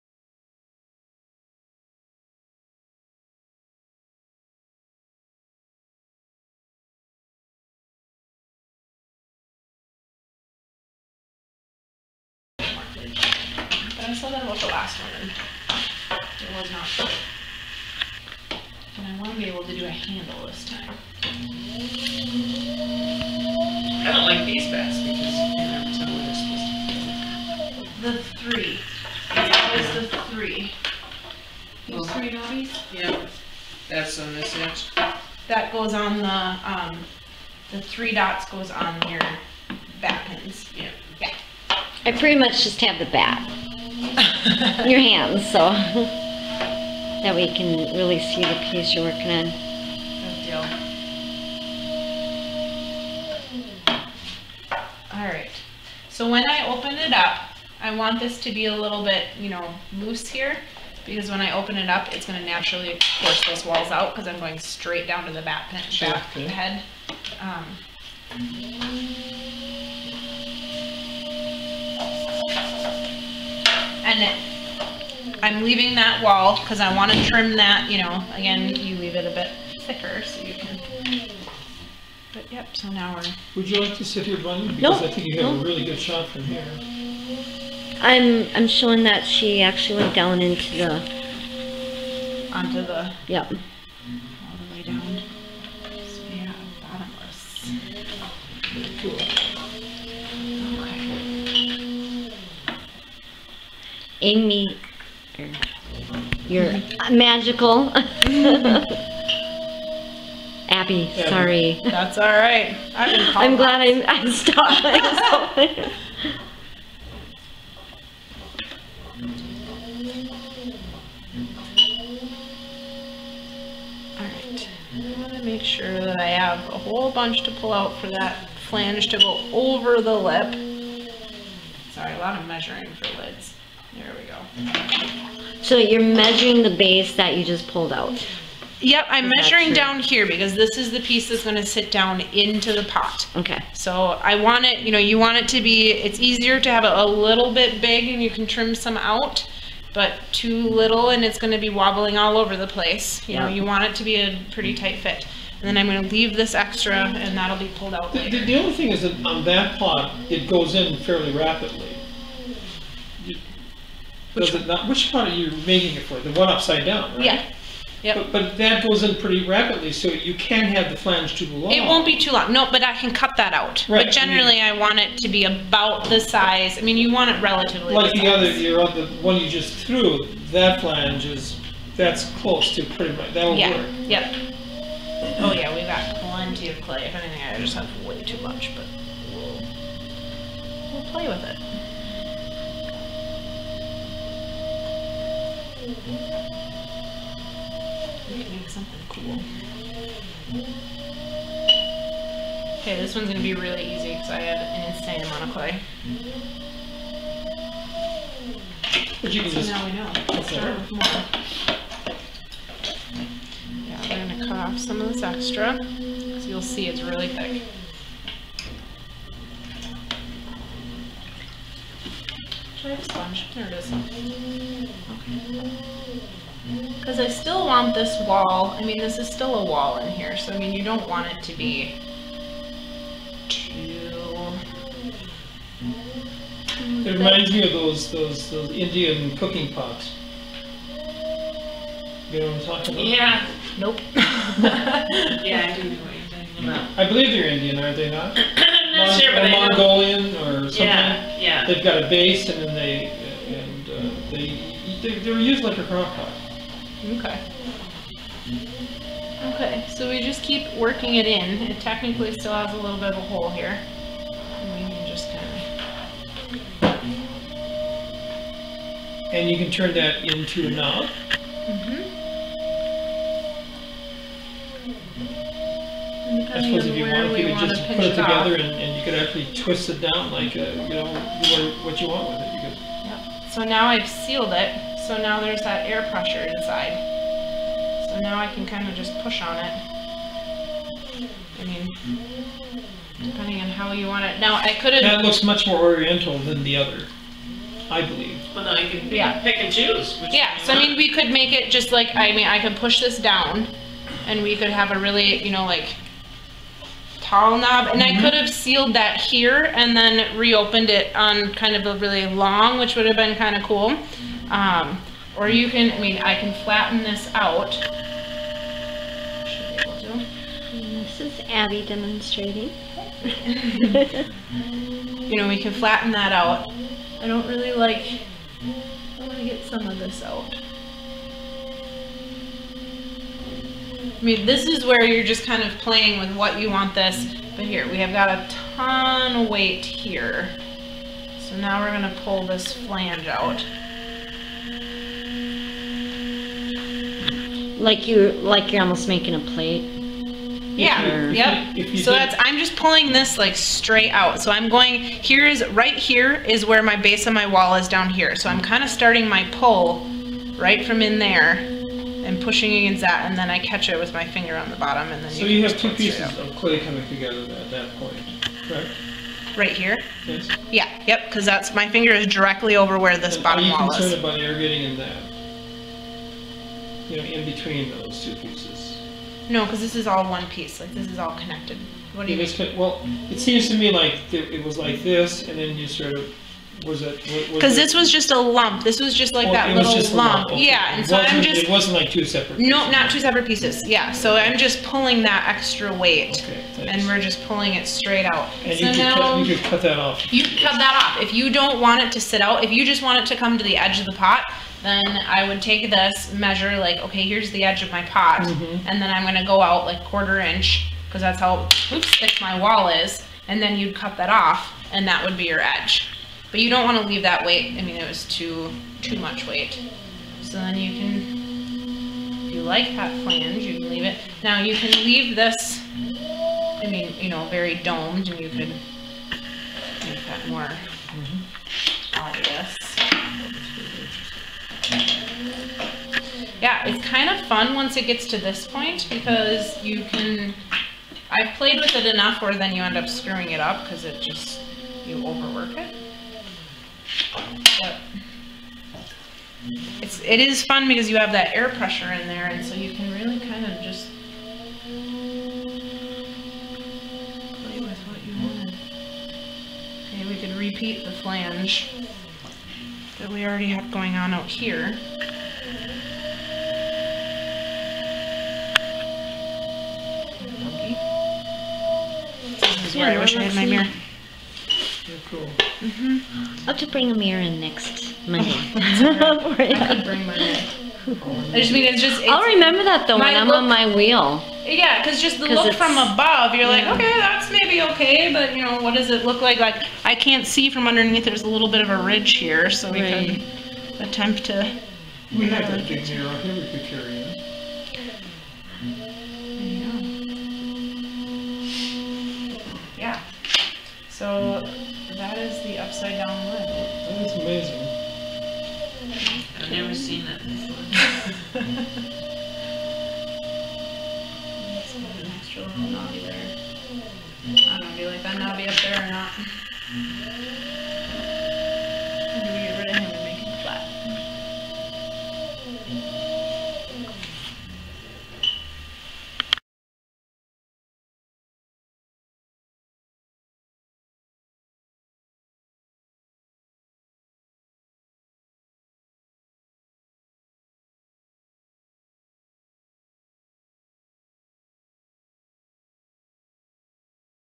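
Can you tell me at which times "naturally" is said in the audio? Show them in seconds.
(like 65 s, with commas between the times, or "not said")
62 s.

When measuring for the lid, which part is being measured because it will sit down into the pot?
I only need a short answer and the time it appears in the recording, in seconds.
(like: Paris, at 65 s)
the base, at 136 s.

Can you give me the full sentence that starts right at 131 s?
Sorry, a lot of measuring for lids.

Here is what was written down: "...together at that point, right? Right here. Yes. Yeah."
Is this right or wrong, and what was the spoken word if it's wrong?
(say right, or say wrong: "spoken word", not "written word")
right.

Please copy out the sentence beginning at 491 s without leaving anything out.
There's a little bit of a ridge here, so we right.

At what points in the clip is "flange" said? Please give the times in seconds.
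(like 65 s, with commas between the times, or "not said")
128 s, 170 s, 180 s, 342 s, 423 s, 461 s.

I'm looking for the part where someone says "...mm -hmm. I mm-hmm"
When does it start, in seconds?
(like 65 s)
307 s.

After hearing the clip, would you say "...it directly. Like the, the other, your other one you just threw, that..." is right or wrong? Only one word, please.
wrong.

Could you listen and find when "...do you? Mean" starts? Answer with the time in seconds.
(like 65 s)
382 s.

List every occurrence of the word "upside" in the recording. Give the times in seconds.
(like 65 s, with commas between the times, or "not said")
166 s.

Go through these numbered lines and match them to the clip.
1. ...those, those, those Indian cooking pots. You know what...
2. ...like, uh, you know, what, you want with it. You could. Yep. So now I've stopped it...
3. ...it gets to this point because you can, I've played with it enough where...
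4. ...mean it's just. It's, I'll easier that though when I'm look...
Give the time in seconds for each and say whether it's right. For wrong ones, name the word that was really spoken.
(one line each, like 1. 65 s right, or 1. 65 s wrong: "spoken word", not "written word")
1. 237 s right
2. 280 s wrong: "sealed", not "stopped"
3. 437 s right
4. 481 s wrong: "remember", not "easier".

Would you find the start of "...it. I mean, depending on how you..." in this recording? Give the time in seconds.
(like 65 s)
289 s.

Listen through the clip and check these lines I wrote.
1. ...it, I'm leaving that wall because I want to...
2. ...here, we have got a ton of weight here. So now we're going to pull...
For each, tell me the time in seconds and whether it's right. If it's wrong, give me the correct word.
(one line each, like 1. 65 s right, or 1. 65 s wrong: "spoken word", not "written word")
1. 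74 s right
2. 337 s right.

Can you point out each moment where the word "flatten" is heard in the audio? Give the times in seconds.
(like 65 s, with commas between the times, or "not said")
316 s, 325 s.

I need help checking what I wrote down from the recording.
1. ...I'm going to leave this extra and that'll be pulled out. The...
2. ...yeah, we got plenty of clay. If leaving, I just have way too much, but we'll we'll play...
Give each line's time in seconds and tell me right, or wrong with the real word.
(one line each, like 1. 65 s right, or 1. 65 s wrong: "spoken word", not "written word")
1. 155 s right
2. 185 s wrong: "anything", not "leaving".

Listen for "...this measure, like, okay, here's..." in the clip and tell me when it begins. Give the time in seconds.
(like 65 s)
405 s.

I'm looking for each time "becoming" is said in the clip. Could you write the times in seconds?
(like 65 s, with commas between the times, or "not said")
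not said.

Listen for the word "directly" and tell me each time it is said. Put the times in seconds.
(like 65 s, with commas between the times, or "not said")
372 s.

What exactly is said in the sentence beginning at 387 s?
Because this was just a lump.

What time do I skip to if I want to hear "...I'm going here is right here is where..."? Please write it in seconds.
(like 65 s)
354 s.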